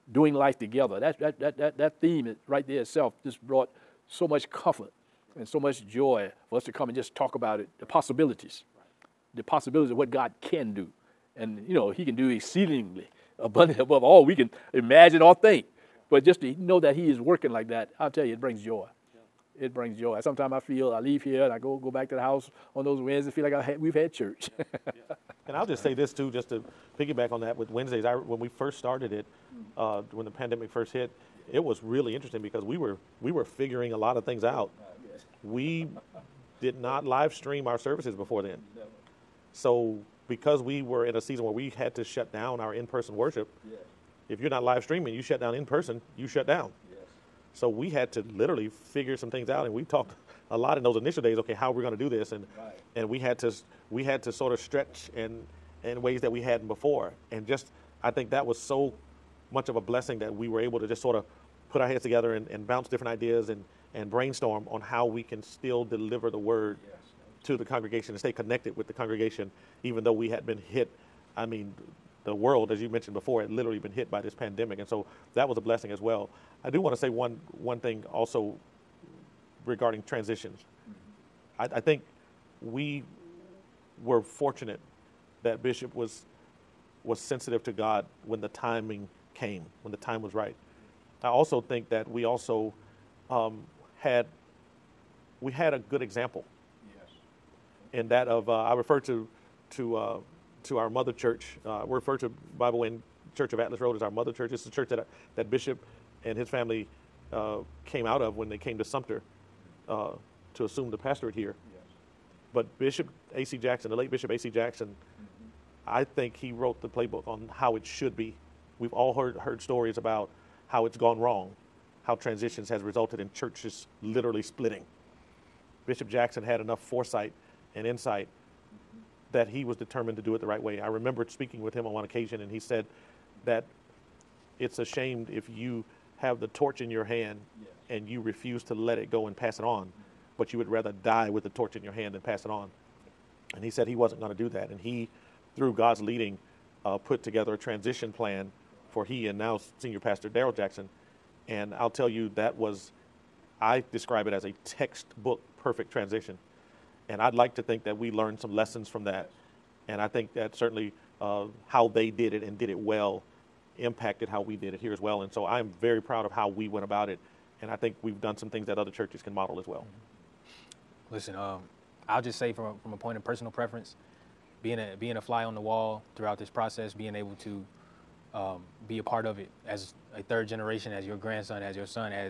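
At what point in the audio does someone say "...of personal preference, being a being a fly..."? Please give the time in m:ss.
2:53.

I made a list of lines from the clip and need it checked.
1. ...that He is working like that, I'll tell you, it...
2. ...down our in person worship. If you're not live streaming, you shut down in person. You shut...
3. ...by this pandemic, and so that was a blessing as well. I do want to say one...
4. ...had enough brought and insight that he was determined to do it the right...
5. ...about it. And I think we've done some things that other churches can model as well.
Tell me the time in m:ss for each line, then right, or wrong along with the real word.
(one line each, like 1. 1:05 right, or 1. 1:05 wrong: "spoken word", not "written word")
1. 0:16 right
2. 0:42 right
3. 1:14 right
4. 2:06 wrong: "foresight", not "brought"
5. 2:46 right.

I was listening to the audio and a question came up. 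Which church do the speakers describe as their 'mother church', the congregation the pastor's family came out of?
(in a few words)
Bible Way Church of Atlas Road.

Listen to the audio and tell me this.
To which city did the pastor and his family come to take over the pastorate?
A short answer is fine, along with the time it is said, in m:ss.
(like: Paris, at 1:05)
Sumter, at 1:48.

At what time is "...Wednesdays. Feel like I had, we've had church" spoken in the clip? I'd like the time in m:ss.
0:23.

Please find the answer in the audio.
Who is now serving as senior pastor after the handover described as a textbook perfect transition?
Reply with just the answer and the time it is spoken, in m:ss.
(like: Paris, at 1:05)
Daryl Jackson, at 2:30.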